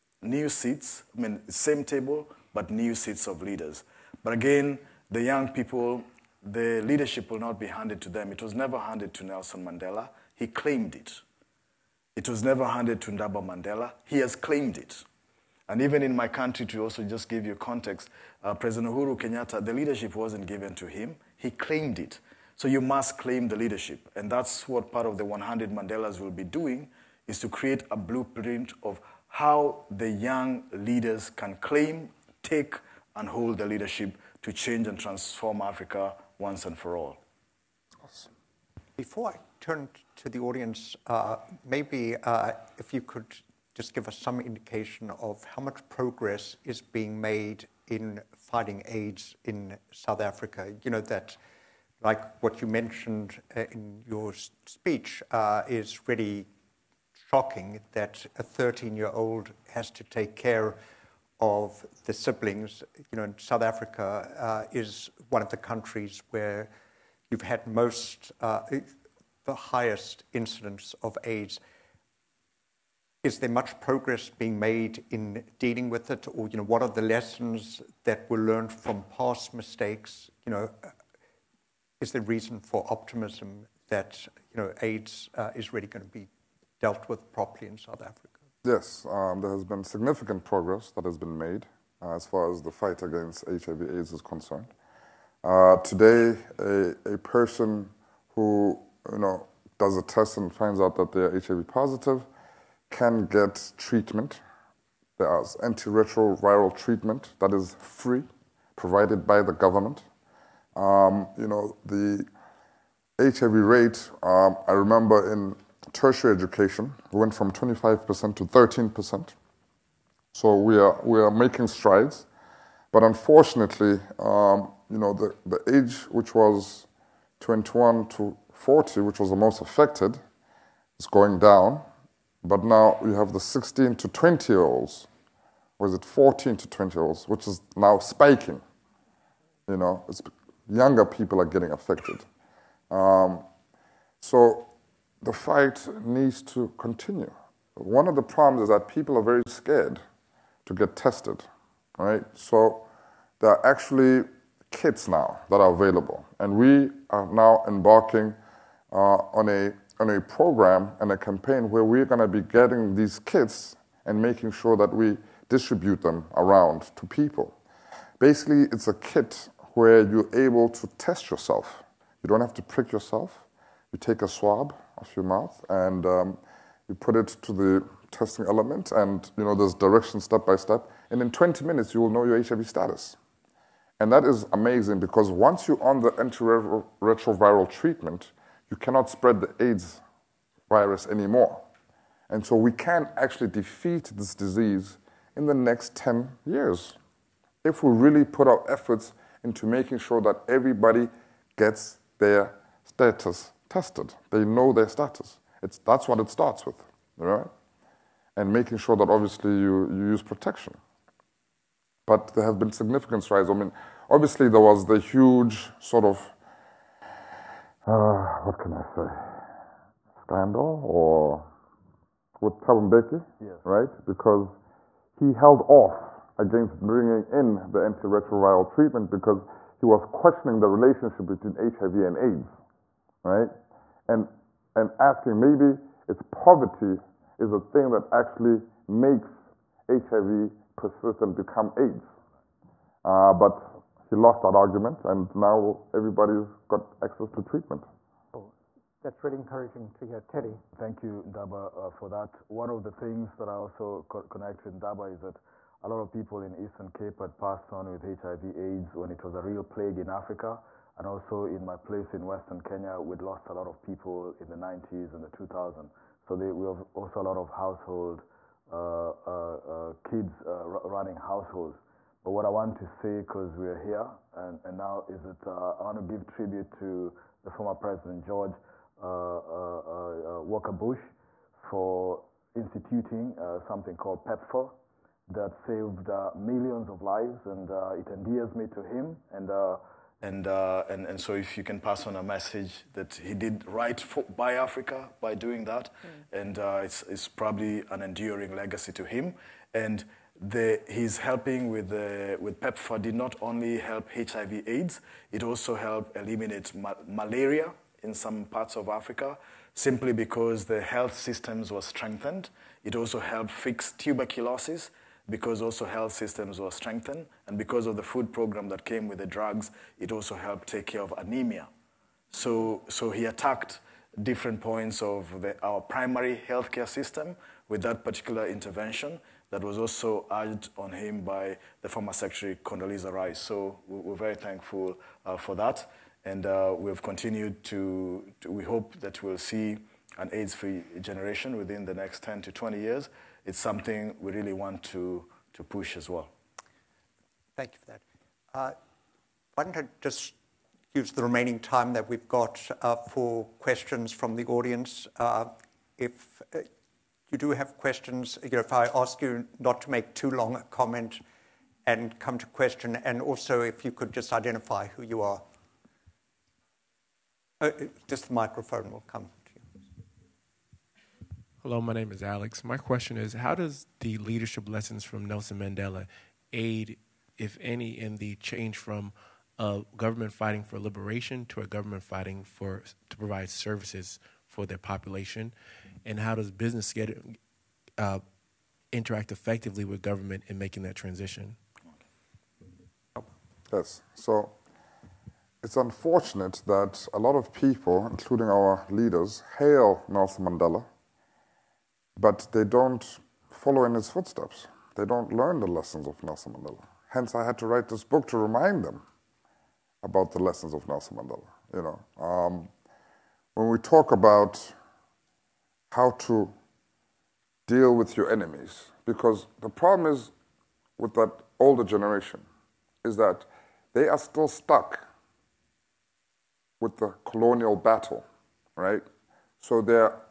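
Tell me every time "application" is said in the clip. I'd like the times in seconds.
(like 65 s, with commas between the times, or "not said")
not said.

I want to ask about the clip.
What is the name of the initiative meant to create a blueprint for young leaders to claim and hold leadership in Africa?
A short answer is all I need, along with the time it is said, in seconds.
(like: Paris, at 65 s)
100 Mandelas, at 25 s.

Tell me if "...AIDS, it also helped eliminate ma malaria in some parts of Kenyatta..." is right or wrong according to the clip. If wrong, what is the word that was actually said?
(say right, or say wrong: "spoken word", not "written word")
wrong: "Africa", not "Kenyatta".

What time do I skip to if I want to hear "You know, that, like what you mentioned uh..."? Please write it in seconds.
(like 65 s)
50 s.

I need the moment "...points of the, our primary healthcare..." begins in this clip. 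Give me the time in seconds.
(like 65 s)
324 s.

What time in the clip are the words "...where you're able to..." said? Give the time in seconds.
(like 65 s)
169 s.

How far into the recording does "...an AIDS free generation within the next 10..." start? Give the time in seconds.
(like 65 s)
340 s.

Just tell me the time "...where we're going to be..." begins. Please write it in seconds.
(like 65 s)
161 s.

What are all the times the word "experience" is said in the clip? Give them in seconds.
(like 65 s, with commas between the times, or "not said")
not said.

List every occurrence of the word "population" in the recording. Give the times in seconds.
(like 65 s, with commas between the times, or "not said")
384 s.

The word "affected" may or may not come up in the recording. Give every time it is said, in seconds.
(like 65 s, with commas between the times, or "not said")
129 s, 141 s.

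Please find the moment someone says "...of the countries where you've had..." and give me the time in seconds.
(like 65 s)
65 s.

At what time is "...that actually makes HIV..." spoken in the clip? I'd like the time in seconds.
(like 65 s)
237 s.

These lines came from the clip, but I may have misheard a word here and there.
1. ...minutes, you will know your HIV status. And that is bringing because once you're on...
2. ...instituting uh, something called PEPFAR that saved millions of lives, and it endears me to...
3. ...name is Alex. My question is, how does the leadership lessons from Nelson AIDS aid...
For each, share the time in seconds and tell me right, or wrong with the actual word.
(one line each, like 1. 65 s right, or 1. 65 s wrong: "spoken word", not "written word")
1. 181 s wrong: "amazing", not "bringing"
2. 282 s right
3. 371 s wrong: "Mandela", not "AIDS".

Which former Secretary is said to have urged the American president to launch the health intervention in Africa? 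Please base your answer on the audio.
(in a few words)
Condoleezza Rice.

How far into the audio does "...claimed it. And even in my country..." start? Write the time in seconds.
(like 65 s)
14 s.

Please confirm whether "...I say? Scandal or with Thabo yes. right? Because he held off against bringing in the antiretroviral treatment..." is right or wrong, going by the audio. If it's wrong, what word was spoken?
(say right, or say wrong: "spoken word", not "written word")
right.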